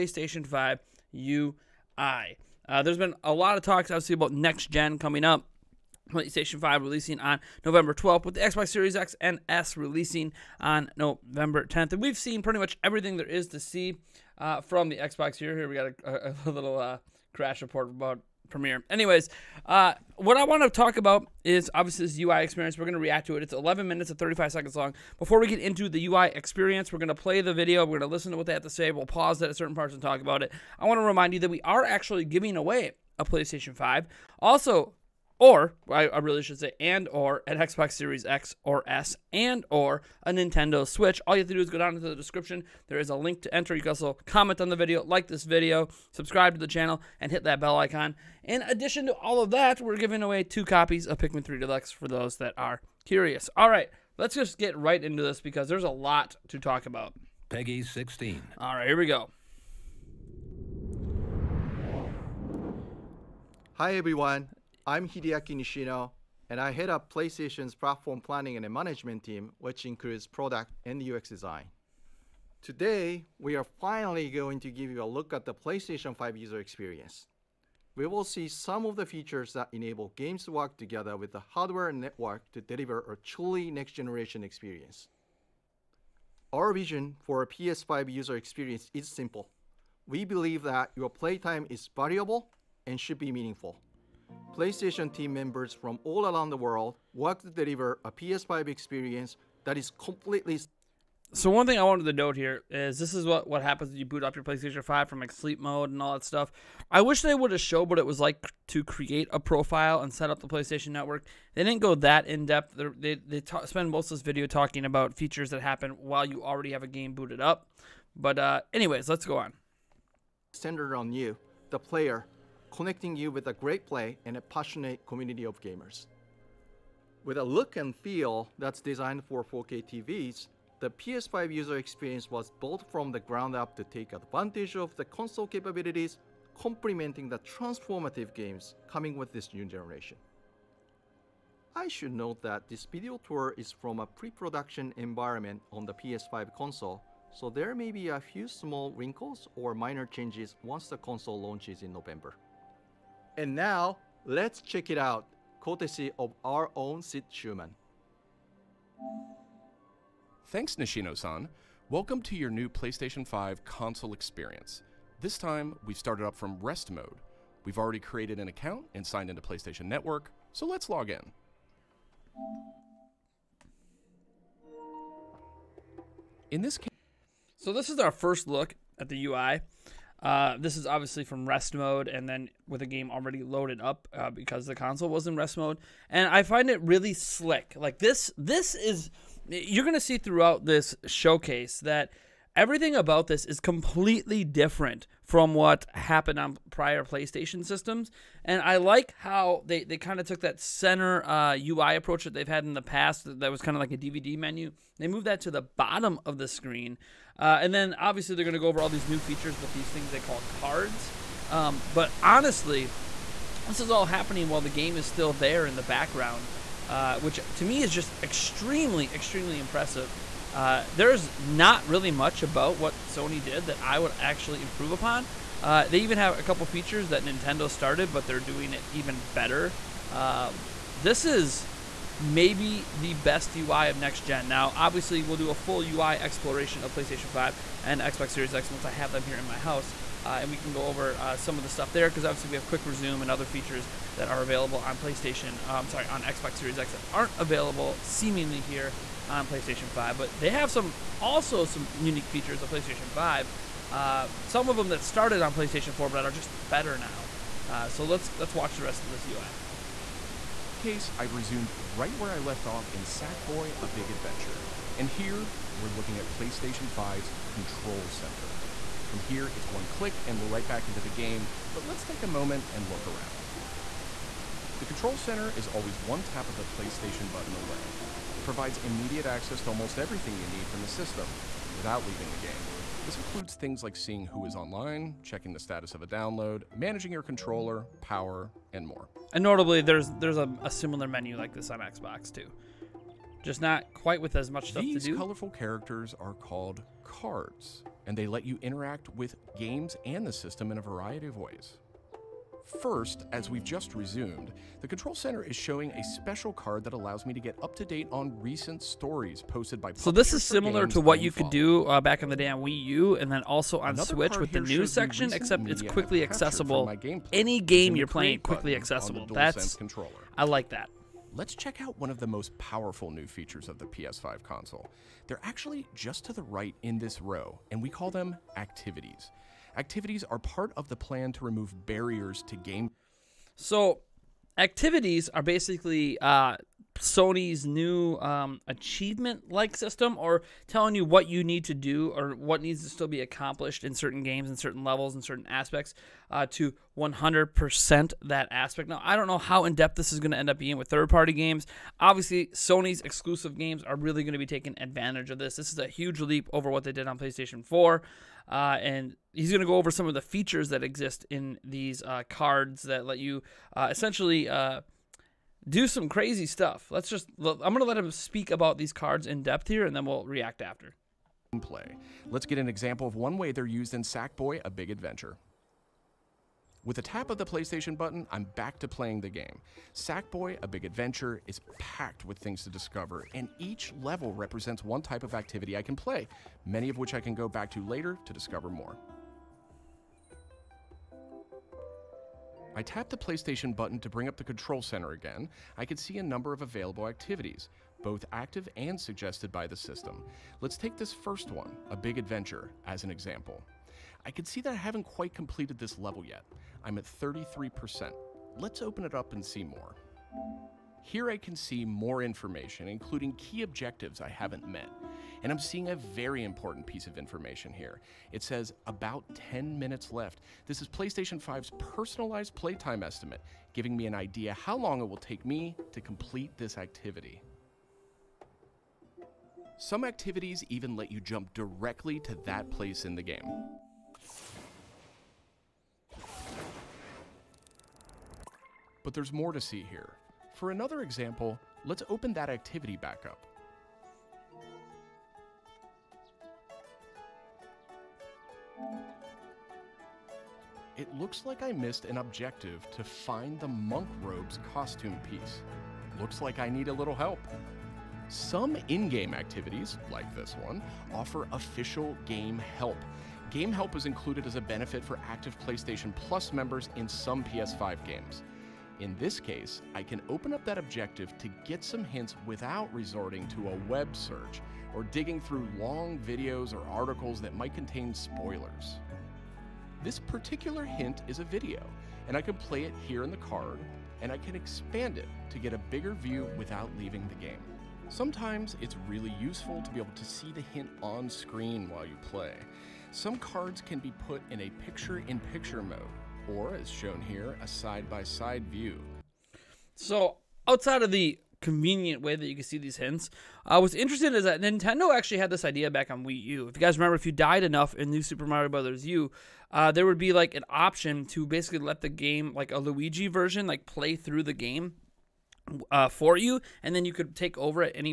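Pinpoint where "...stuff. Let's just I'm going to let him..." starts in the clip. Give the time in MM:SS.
06:06.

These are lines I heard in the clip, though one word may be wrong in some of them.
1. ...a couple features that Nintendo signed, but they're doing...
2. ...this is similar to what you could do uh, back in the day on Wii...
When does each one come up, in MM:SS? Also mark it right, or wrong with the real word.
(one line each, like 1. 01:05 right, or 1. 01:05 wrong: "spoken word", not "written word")
1. 03:46 wrong: "started", not "signed"
2. 05:10 right.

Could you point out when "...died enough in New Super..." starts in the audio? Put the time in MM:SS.
08:27.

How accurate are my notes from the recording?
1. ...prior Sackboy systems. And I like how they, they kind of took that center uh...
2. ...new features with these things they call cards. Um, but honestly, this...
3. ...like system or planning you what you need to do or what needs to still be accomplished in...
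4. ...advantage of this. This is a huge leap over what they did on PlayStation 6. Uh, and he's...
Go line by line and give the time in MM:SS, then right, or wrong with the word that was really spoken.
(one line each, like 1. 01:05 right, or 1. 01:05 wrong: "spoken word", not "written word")
1. 03:16 wrong: "PlayStation", not "Sackboy"
2. 03:29 right
3. 05:39 wrong: "telling", not "planning"
4. 05:54 wrong: "4", not "6".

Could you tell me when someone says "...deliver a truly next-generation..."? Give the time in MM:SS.
01:22.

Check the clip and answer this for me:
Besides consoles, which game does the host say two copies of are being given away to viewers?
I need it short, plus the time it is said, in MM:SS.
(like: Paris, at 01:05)
Pikmin 3 Deluxe, at 00:51.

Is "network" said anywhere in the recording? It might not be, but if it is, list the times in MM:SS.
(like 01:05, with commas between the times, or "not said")
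01:21, 01:50, 02:49.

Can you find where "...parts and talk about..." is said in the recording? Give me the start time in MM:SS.
00:29.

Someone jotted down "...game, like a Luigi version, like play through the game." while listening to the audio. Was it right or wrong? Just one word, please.
right.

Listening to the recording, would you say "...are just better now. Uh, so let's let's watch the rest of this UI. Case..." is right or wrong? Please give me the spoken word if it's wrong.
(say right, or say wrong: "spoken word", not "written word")
right.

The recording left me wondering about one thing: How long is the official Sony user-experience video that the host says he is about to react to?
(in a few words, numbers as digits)
11 minutes 35 seconds.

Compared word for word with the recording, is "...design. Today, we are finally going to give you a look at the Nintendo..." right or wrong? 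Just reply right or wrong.
wrong.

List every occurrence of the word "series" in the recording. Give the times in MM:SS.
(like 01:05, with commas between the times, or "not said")
00:08, 00:37, 03:58, 04:06.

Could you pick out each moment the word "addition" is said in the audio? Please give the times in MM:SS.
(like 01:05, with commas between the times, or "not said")
00:48.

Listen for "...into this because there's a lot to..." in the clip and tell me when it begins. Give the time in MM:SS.
00:55.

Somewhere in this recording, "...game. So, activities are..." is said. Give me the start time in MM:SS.
05:32.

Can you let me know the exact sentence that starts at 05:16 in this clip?
Game Any game you're playing, quickly accessible.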